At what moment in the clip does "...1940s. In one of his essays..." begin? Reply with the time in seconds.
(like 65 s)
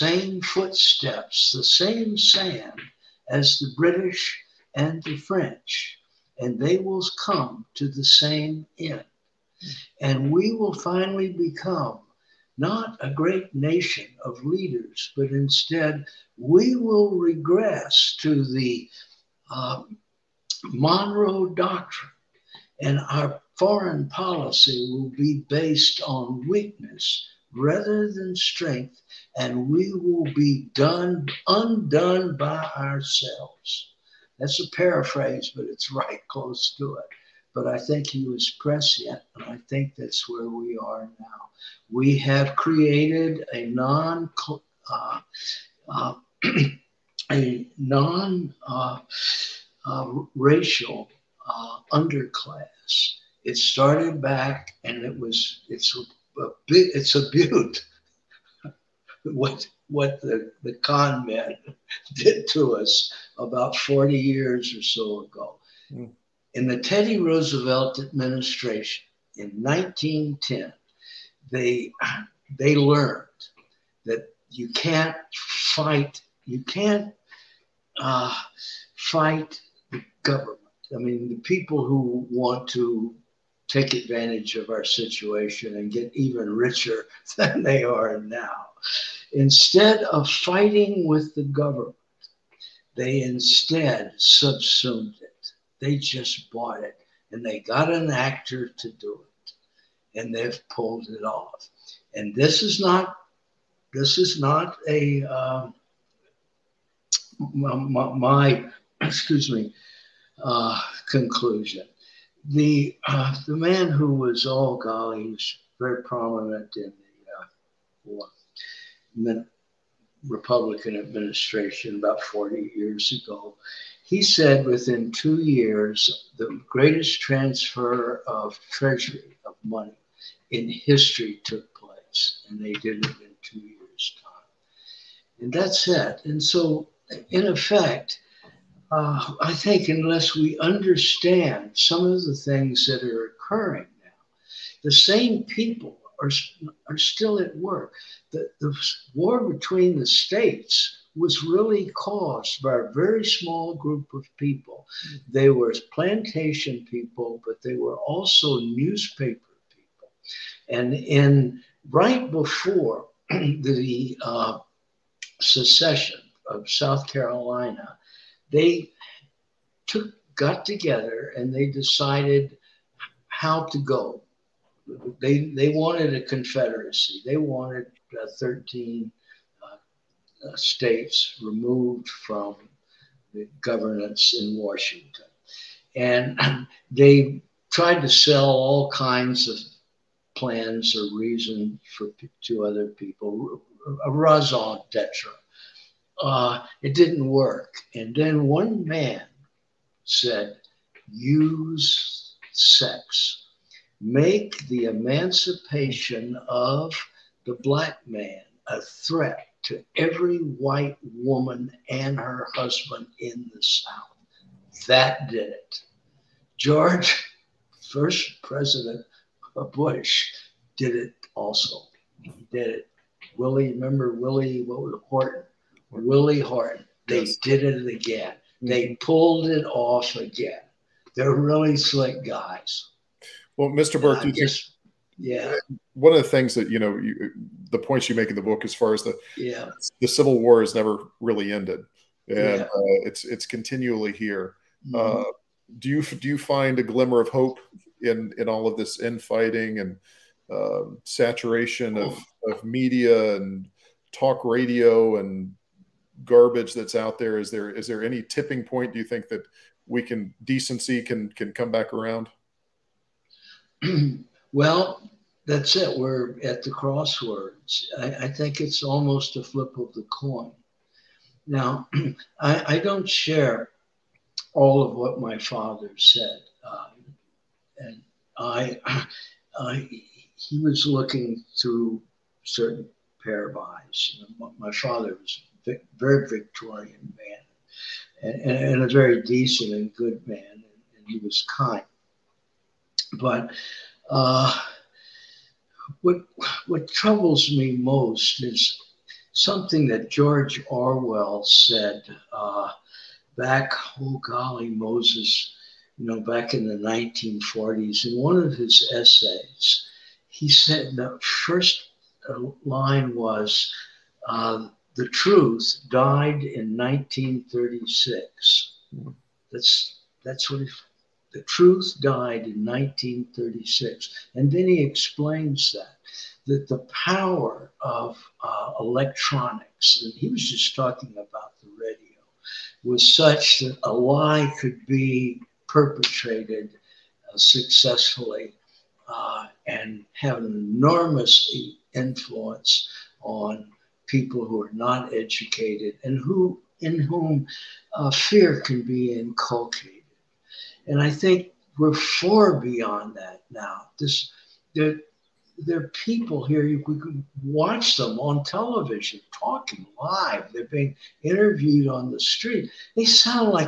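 306 s.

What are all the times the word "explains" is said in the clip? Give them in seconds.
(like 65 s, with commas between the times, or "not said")
324 s.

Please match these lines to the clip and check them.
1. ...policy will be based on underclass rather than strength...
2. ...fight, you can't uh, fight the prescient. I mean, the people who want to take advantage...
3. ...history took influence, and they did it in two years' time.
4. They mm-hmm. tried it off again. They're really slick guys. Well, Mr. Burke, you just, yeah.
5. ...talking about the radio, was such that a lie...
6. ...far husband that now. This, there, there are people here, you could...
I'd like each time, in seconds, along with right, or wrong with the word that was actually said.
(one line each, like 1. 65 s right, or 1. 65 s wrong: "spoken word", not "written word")
1. 24 s wrong: "weakness", not "underclass"
2. 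75 s wrong: "government", not "prescient"
3. 130 s wrong: "place", not "influence"
4. 228 s wrong: "pulled", not "tried"
5. 330 s right
6. 351 s wrong: "beyond", not "husband".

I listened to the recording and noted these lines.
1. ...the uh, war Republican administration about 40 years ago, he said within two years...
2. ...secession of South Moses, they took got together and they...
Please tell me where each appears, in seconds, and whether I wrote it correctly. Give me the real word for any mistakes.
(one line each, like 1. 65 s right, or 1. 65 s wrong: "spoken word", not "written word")
1. 116 s right
2. 165 s wrong: "Carolina", not "Moses".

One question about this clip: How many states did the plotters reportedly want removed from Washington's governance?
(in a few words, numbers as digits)
13.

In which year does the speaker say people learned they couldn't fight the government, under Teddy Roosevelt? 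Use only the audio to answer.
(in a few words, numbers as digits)
1910.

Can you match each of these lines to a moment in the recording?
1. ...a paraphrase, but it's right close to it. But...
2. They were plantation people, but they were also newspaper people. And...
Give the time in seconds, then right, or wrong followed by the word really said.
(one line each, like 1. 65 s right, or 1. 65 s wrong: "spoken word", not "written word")
1. 34 s right
2. 155 s right.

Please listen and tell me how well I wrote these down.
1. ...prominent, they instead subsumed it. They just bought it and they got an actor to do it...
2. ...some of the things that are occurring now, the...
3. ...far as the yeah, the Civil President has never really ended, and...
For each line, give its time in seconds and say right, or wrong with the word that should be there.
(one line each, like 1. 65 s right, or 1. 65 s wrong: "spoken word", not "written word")
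1. 91 s wrong: "government", not "prominent"
2. 141 s right
3. 238 s wrong: "War", not "President".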